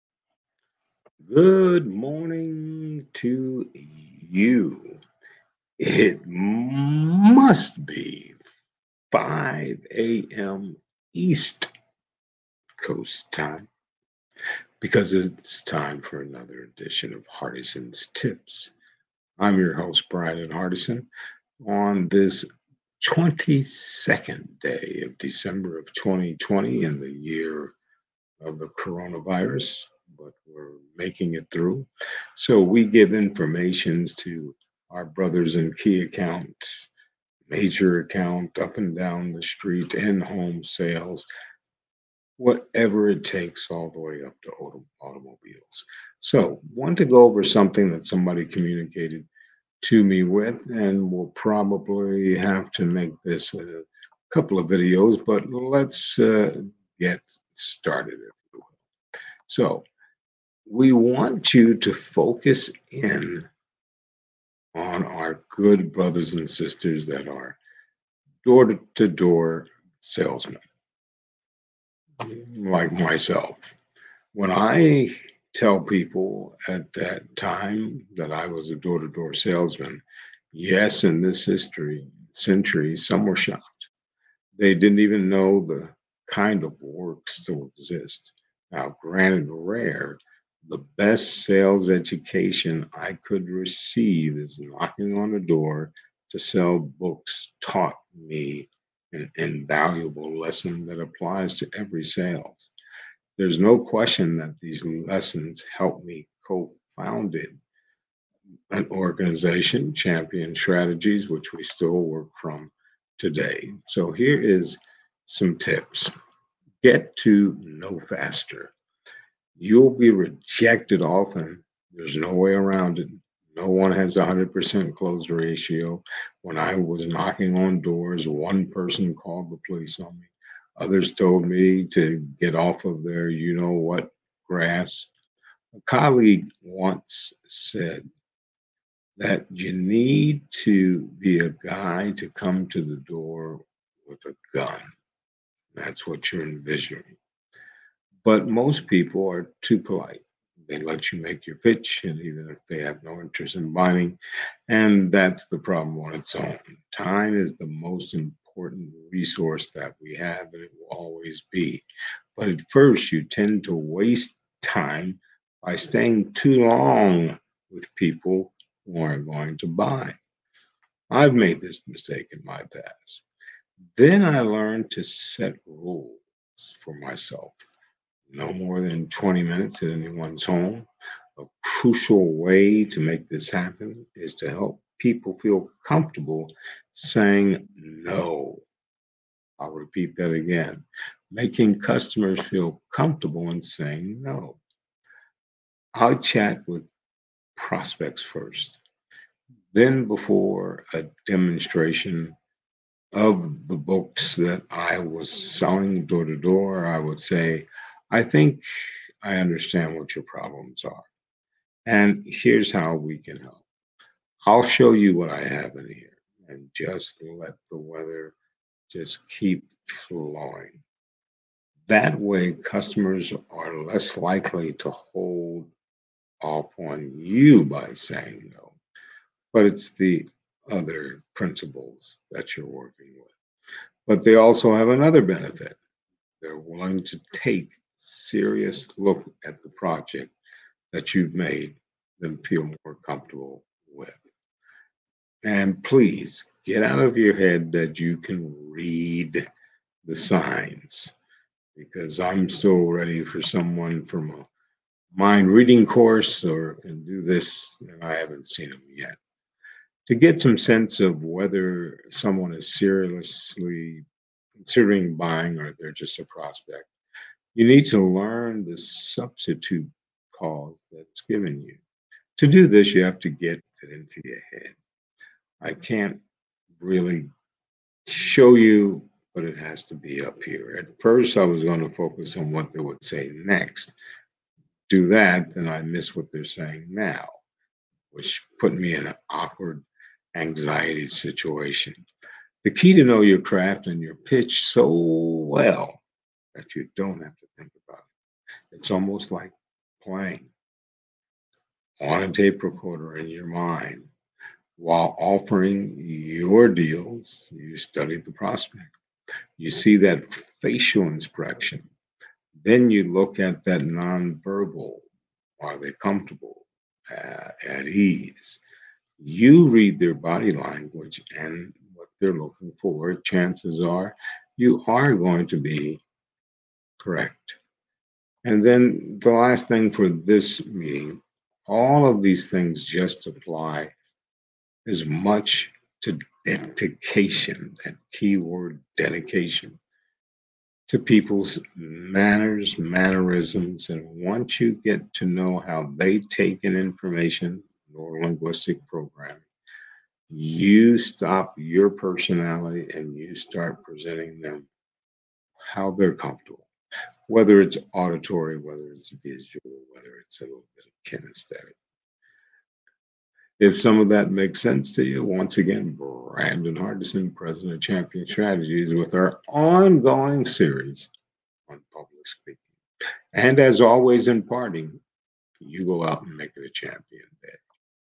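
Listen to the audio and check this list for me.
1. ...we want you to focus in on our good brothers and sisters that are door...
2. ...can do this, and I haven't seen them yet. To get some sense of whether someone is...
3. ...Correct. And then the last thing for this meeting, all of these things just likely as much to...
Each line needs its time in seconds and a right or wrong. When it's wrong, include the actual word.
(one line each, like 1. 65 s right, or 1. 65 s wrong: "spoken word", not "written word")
1. 60 s right
2. 256 s right
3. 327 s wrong: "apply", not "likely".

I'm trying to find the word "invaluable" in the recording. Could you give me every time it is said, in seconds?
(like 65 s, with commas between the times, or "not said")
99 s.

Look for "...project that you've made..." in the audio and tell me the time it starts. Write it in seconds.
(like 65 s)
239 s.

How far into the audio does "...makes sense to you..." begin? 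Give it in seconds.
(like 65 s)
364 s.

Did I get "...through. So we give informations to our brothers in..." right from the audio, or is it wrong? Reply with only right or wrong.
right.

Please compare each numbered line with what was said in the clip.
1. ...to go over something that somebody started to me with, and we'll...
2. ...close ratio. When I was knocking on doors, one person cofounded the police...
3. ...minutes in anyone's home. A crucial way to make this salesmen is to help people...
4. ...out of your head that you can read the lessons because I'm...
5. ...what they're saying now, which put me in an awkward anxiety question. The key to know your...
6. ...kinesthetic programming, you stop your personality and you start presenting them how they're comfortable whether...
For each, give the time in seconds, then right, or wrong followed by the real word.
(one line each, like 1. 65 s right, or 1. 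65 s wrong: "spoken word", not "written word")
1. 46 s wrong: "communicated", not "started"
2. 124 s wrong: "called", not "cofounded"
3. 179 s wrong: "happen", not "salesmen"
4. 246 s wrong: "signs", not "lessons"
5. 286 s wrong: "situation", not "question"
6. 348 s wrong: "linguistic", not "kinesthetic".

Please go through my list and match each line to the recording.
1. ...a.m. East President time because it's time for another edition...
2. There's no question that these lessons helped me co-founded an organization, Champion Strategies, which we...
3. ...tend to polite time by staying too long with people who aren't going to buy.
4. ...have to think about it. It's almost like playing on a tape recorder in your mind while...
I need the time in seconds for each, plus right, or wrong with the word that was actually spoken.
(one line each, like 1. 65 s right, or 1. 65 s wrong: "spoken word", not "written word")
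1. 9 s wrong: "Coast", not "President"
2. 103 s right
3. 163 s wrong: "waste", not "polite"
4. 297 s right.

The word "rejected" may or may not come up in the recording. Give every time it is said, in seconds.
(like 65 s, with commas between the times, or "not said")
120 s.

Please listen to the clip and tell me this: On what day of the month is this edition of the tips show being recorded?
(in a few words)
22.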